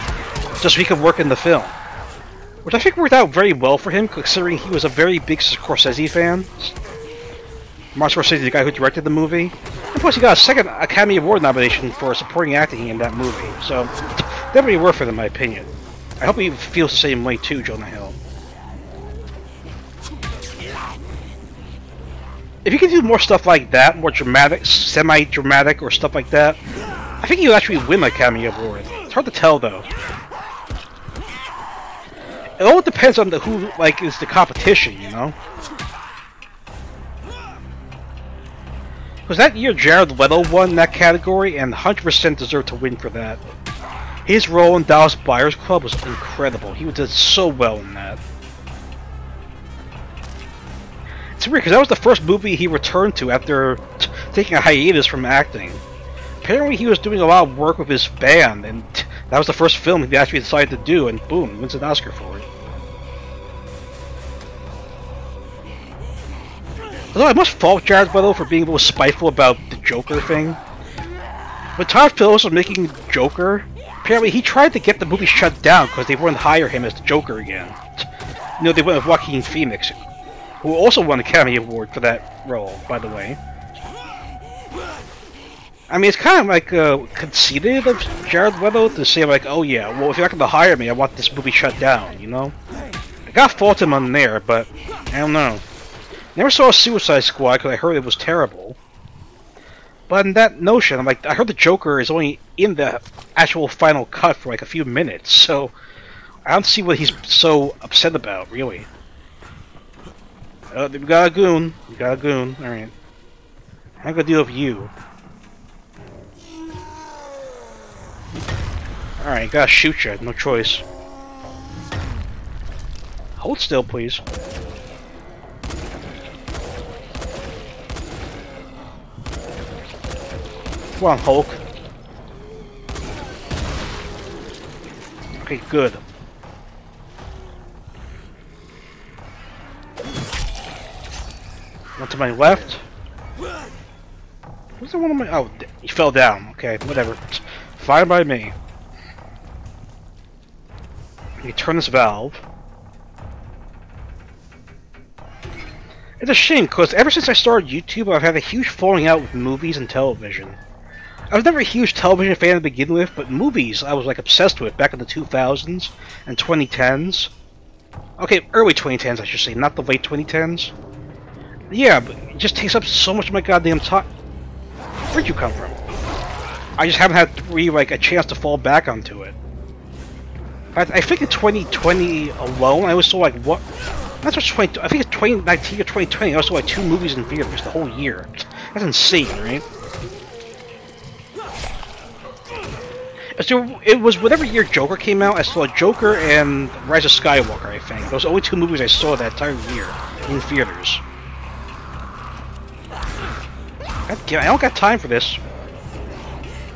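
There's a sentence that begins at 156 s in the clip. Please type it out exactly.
It's a shame, because ever since I started YouTube, I've had a huge falling out with movies and television.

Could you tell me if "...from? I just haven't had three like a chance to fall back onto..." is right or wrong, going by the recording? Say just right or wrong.
right.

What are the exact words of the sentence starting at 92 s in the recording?
I got fault him on there, but I don't know.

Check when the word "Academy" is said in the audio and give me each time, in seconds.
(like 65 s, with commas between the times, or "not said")
10 s, 28 s, 81 s.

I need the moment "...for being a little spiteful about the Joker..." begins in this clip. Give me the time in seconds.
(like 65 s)
68 s.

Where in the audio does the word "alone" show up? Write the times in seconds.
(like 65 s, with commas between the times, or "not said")
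182 s.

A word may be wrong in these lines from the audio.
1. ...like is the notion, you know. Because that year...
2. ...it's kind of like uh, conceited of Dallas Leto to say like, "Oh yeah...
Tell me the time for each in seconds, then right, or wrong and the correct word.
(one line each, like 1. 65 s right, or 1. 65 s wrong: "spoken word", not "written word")
1. 33 s wrong: "competition", not "notion"
2. 86 s wrong: "Jared", not "Dallas".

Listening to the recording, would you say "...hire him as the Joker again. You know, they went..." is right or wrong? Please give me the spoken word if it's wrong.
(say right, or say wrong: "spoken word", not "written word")
right.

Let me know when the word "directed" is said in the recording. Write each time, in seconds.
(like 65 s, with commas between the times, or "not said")
8 s.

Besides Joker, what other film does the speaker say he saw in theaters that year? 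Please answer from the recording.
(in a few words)
Rise of Skywalker.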